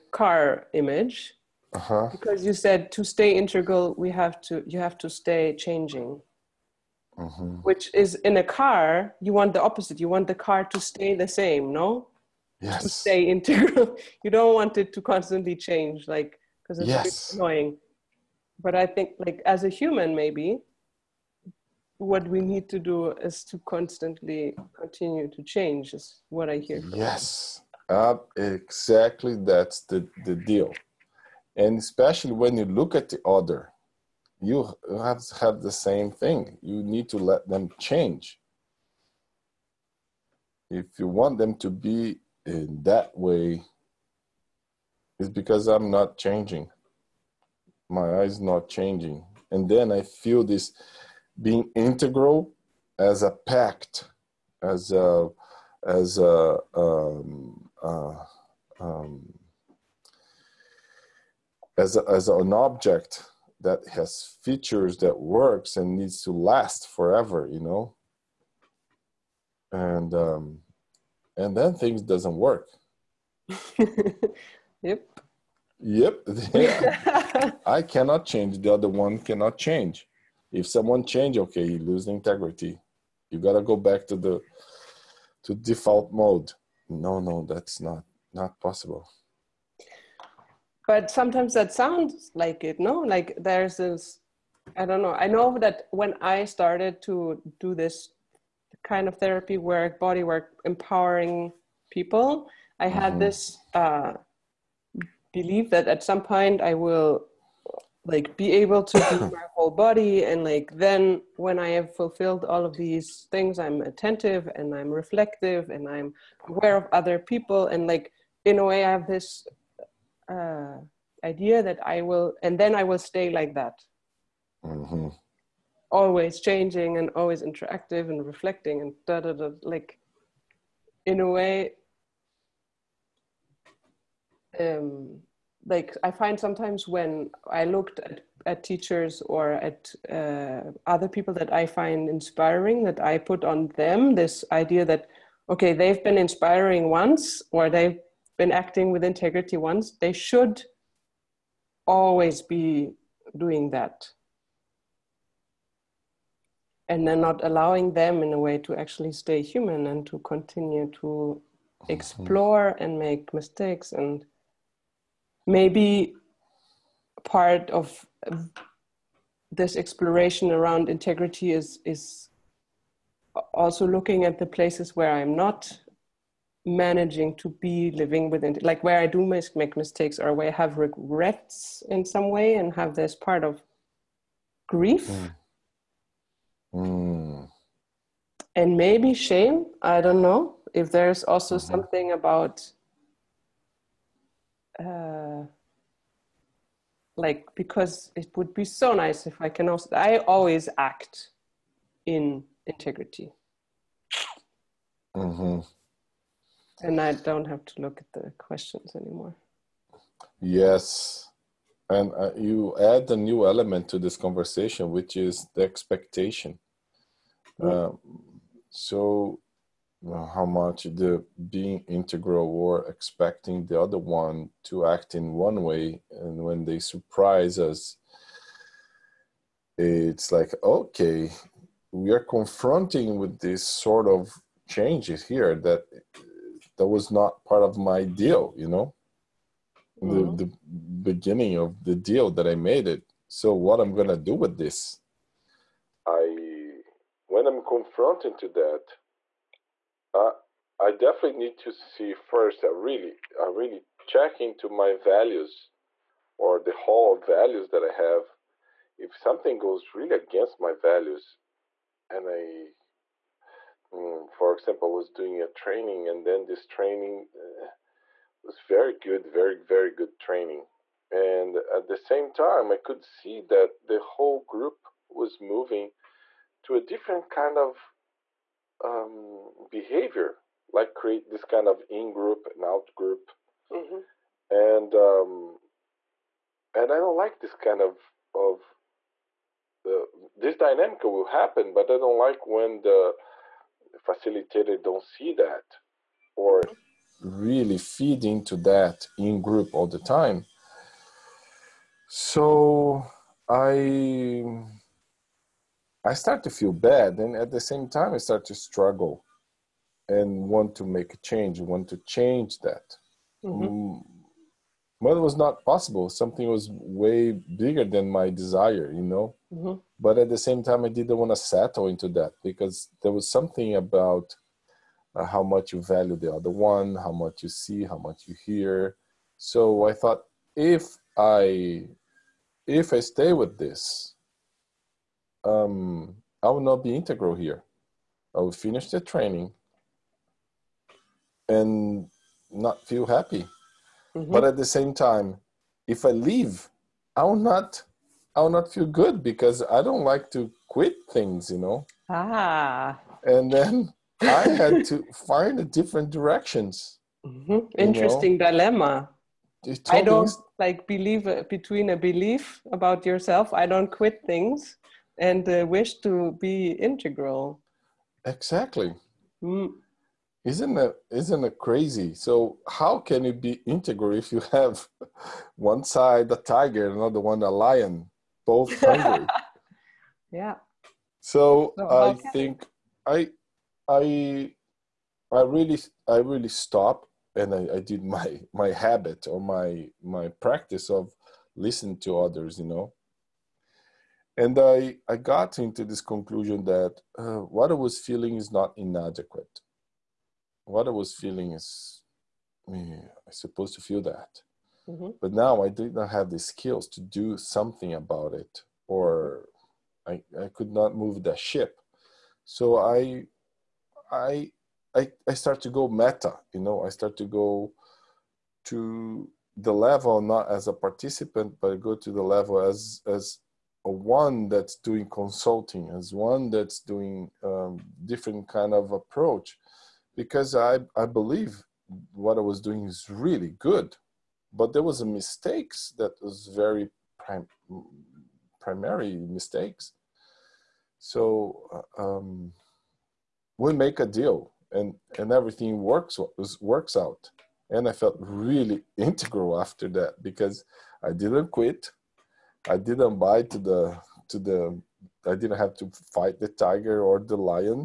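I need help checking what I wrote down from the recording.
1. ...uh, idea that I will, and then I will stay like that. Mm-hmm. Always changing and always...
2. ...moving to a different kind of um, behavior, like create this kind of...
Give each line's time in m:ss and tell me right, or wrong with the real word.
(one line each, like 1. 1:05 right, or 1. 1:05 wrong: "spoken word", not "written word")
1. 2:00 right
2. 4:35 right.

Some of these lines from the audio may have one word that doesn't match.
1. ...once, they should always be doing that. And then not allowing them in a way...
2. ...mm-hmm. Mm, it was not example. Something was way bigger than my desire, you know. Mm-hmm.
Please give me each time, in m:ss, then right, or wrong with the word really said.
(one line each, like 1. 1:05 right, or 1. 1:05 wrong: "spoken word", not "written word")
1. 2:29 right
2. 5:13 wrong: "possible", not "example".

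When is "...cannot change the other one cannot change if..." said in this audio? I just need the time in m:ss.
1:17.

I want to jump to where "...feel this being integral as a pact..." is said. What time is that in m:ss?
0:50.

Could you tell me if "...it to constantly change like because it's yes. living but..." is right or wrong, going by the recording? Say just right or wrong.
wrong.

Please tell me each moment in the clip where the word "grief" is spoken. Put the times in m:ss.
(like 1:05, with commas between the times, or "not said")
3:04.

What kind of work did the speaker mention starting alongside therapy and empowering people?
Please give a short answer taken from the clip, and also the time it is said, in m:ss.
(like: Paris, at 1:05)
Body work, at 1:40.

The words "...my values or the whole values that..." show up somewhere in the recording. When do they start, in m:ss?
4:14.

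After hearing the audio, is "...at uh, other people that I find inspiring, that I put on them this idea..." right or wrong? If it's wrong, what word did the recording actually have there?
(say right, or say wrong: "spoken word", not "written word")
right.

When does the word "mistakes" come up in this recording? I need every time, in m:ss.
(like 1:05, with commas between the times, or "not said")
2:43, 2:59, 7:15, 7:19.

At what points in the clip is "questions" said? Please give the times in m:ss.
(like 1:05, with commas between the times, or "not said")
3:28.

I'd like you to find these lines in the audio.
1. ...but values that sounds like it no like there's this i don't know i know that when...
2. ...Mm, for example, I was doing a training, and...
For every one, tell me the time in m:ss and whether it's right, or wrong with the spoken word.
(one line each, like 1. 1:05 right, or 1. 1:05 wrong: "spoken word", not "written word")
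1. 1:30 wrong: "sometimes", not "values"
2. 4:23 right.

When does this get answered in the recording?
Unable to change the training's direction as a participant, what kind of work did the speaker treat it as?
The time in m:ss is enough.
7:05.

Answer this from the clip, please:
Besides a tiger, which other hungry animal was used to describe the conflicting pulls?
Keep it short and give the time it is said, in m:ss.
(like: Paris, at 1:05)
A lion, at 6:17.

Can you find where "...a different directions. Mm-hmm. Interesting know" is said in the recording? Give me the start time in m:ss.
5:55.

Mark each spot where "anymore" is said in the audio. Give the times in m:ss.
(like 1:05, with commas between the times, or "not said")
3:28.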